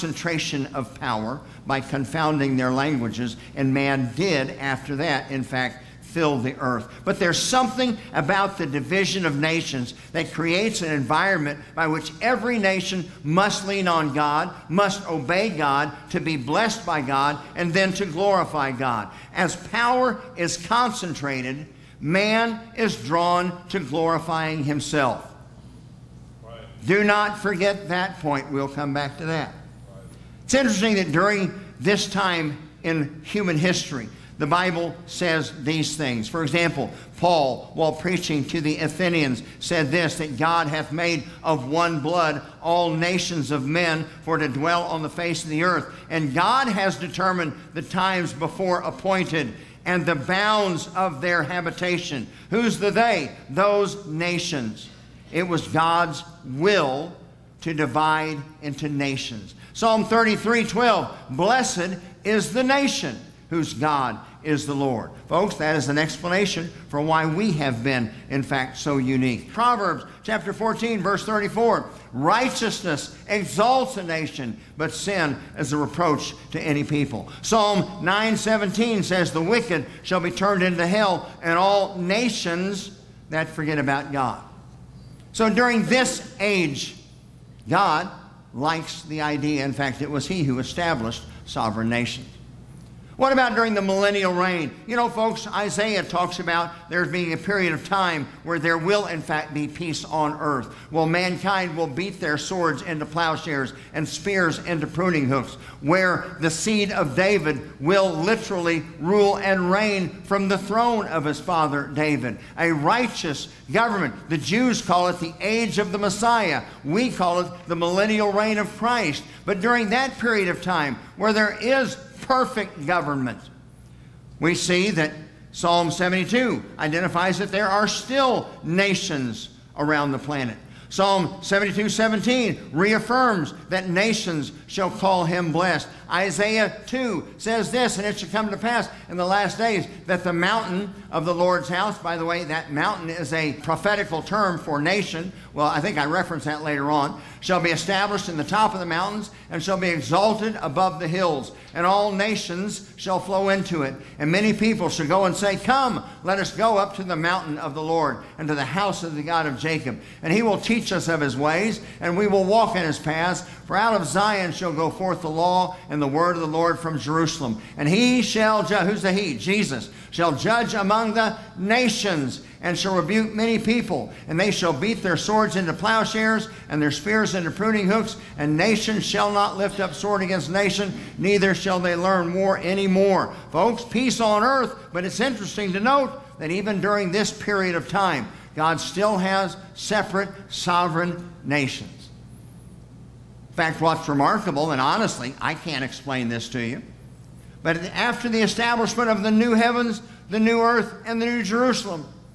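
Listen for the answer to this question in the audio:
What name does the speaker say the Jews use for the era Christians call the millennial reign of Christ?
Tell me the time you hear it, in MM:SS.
01:55.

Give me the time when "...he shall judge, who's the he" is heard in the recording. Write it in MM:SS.
02:47.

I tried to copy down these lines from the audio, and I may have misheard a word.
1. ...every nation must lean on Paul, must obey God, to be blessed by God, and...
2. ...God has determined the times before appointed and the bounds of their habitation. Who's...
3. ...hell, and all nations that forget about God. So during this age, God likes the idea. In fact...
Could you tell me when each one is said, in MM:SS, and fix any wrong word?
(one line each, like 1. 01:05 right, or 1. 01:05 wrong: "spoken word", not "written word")
1. 00:12 wrong: "God", not "Paul"
2. 00:46 right
3. 01:20 right.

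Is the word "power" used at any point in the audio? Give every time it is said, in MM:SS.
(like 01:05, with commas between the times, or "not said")
00:00, 00:19.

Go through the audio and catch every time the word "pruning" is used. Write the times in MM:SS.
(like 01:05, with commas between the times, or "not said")
01:44, 02:57.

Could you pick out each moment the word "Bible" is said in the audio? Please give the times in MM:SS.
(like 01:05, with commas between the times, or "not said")
00:34.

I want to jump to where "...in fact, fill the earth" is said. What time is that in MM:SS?
00:05.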